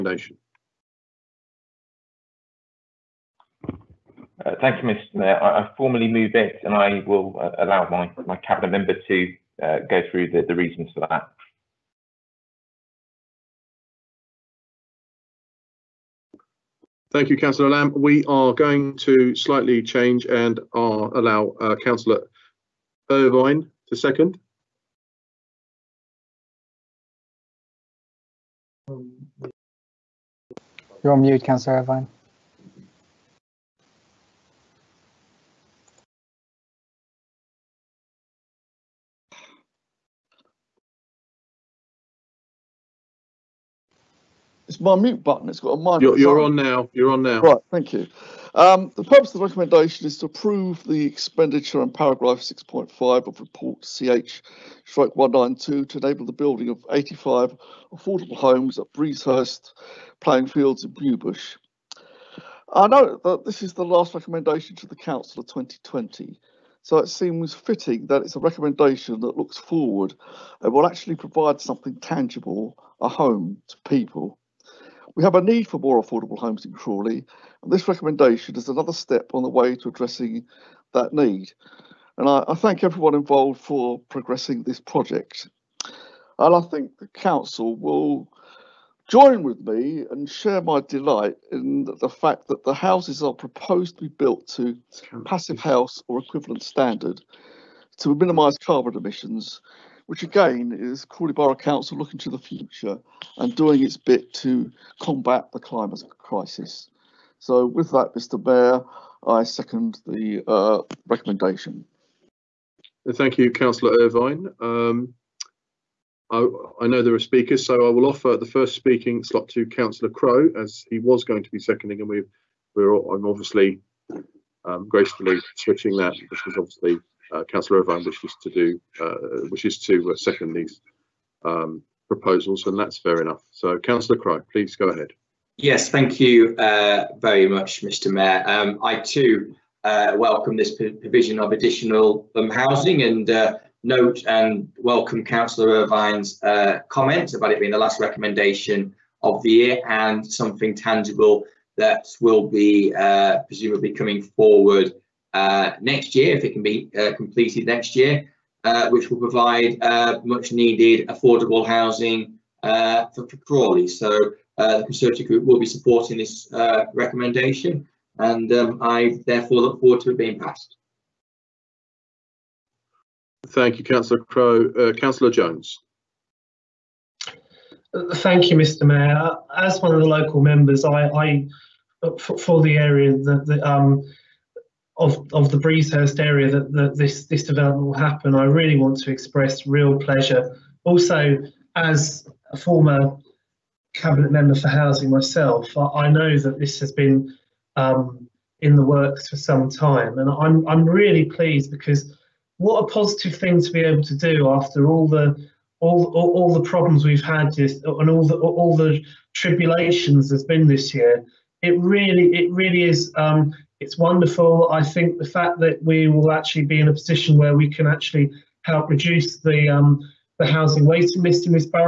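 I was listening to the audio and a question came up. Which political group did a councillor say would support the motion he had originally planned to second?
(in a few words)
Conservative Group.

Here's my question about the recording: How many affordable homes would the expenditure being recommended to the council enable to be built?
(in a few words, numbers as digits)
85.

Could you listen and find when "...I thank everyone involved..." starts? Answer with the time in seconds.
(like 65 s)
82 s.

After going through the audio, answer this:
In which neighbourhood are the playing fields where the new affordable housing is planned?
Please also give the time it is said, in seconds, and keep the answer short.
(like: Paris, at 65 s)
Bewbush, at 60 s.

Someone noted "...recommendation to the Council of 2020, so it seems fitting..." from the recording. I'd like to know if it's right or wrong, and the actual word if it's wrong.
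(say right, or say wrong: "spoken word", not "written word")
right.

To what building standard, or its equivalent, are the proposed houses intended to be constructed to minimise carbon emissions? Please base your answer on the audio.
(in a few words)
Passive house.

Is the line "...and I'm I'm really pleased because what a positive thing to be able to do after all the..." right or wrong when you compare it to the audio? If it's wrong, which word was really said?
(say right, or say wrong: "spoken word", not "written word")
right.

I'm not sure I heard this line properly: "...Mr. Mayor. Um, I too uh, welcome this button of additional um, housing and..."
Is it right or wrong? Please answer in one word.
wrong.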